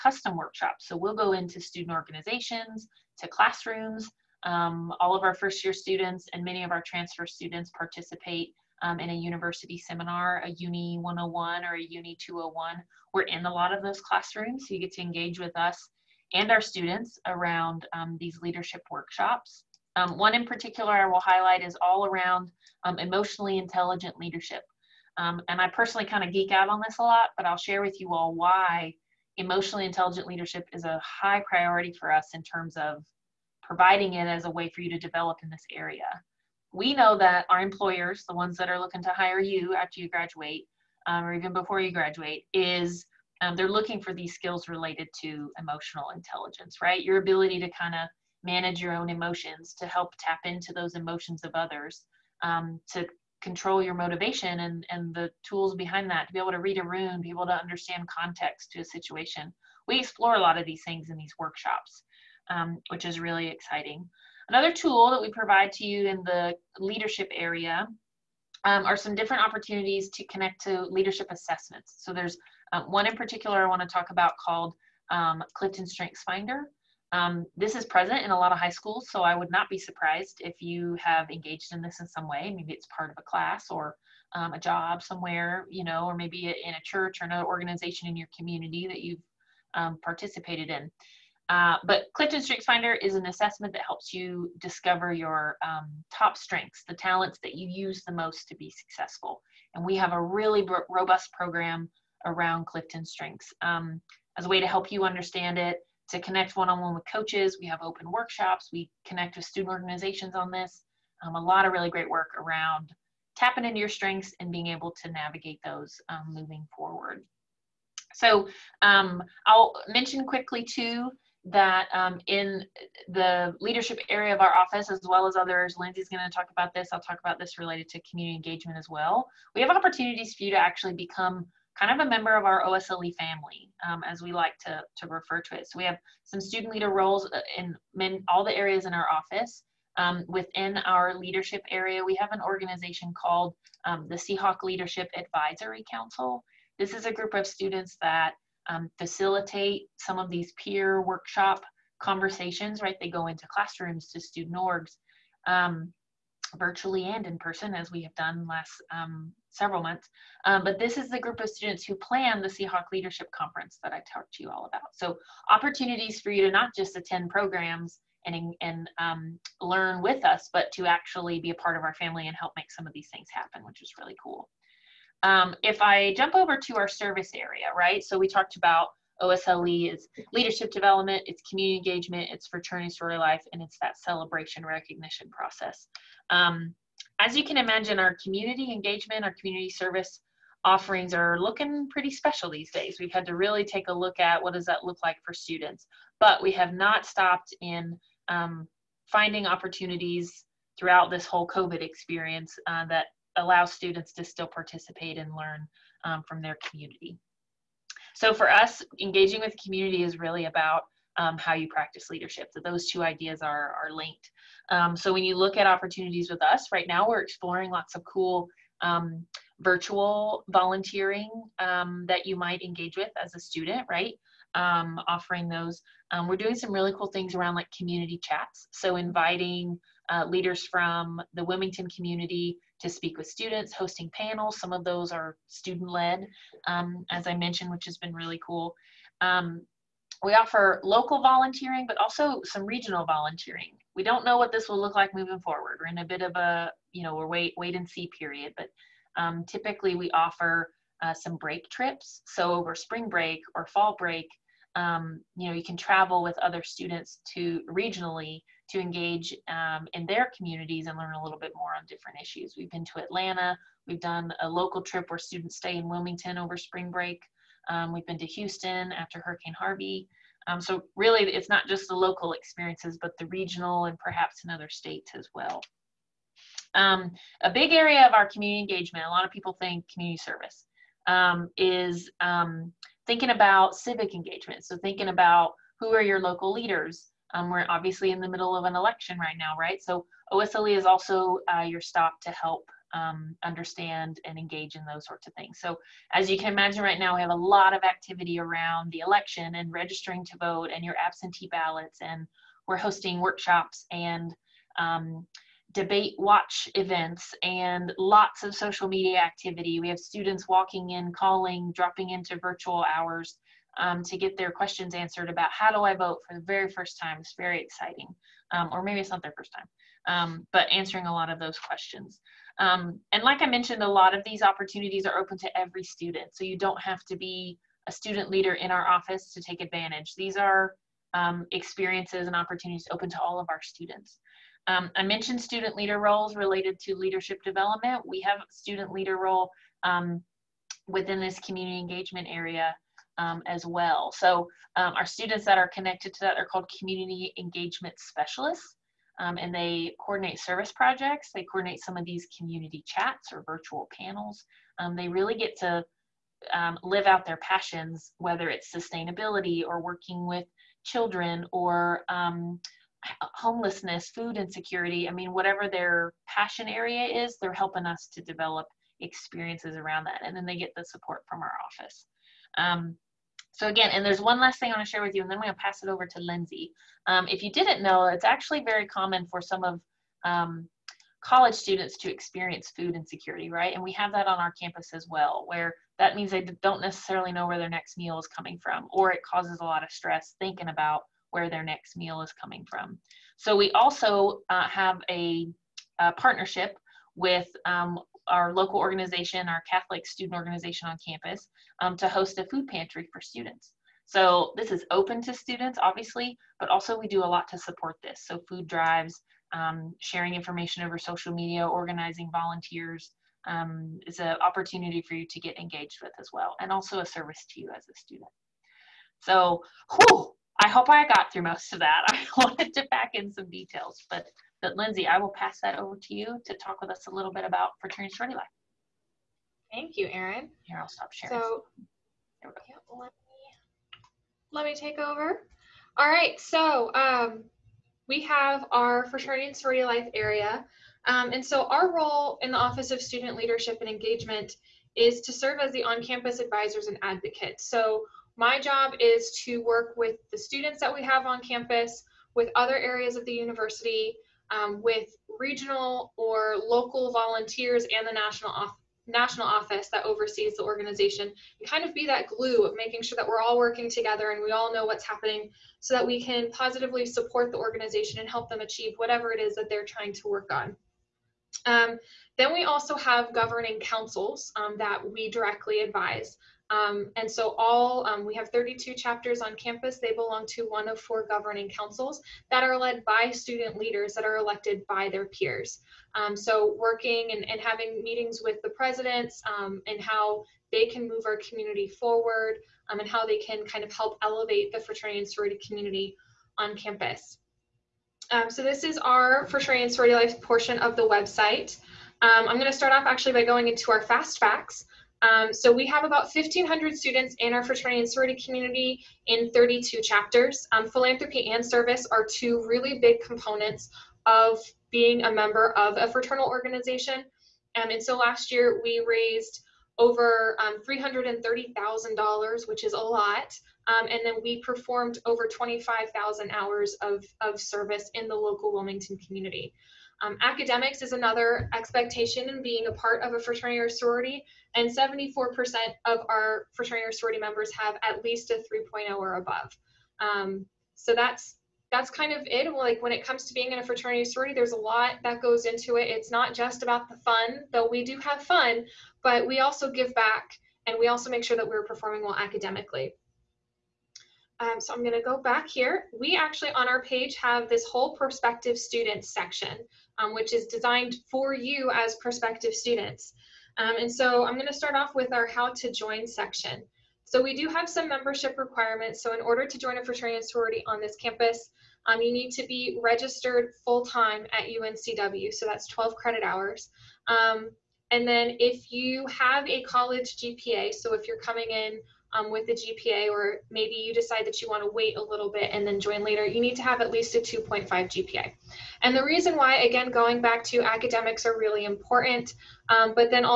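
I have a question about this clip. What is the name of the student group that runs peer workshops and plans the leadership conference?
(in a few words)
Seahawk Leadership Advisory Council.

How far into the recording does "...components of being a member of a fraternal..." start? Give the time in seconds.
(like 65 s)
513 s.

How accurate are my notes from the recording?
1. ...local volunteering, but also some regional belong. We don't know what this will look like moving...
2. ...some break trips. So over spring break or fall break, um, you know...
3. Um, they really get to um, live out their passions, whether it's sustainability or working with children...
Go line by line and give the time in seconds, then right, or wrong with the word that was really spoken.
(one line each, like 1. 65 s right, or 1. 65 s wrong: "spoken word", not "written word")
1. 240 s wrong: "volunteering", not "belong"
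2. 251 s right
3. 354 s right.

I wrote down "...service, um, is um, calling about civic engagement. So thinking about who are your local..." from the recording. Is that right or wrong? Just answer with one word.
wrong.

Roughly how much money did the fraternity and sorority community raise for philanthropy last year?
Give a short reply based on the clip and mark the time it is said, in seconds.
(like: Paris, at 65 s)
$330,000, at 520 s.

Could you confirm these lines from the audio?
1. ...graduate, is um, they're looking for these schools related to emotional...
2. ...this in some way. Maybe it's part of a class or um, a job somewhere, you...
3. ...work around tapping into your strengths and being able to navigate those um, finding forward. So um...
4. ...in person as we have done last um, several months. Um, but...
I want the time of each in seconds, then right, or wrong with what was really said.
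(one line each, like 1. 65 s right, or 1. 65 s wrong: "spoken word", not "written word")
1. 41 s wrong: "skills", not "schools"
2. 81 s right
3. 112 s wrong: "moving", not "finding"
4. 157 s right.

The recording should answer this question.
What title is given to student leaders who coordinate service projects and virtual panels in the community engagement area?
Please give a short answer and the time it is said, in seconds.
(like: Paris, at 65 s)
community engagement specialists, at 346 s.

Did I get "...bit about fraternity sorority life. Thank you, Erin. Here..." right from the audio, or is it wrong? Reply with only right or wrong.
right.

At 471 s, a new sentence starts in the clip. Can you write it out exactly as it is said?
Um, then we also have governing councils um, that we directly advise.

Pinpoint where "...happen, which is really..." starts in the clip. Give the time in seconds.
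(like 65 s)
173 s.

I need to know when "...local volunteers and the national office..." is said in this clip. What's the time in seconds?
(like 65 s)
456 s.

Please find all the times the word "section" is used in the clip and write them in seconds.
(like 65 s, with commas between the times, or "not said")
559 s, 566 s.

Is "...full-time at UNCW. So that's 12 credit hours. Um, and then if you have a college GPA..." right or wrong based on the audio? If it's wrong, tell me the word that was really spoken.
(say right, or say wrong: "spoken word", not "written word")
right.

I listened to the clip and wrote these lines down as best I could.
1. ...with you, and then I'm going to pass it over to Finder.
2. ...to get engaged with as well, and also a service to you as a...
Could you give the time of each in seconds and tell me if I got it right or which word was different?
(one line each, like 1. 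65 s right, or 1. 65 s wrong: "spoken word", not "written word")
1. 375 s wrong: "Lindsay", not "Finder"
2. 415 s right.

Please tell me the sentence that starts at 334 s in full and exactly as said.
Um, I mentioned student leader roles related to leadership development.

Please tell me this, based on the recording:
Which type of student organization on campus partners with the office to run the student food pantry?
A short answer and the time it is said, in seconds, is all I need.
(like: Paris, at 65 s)
Catholic student organization, at 399 s.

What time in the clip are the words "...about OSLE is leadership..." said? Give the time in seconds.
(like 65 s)
178 s.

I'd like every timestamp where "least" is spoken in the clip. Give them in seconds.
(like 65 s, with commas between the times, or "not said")
538 s, 587 s.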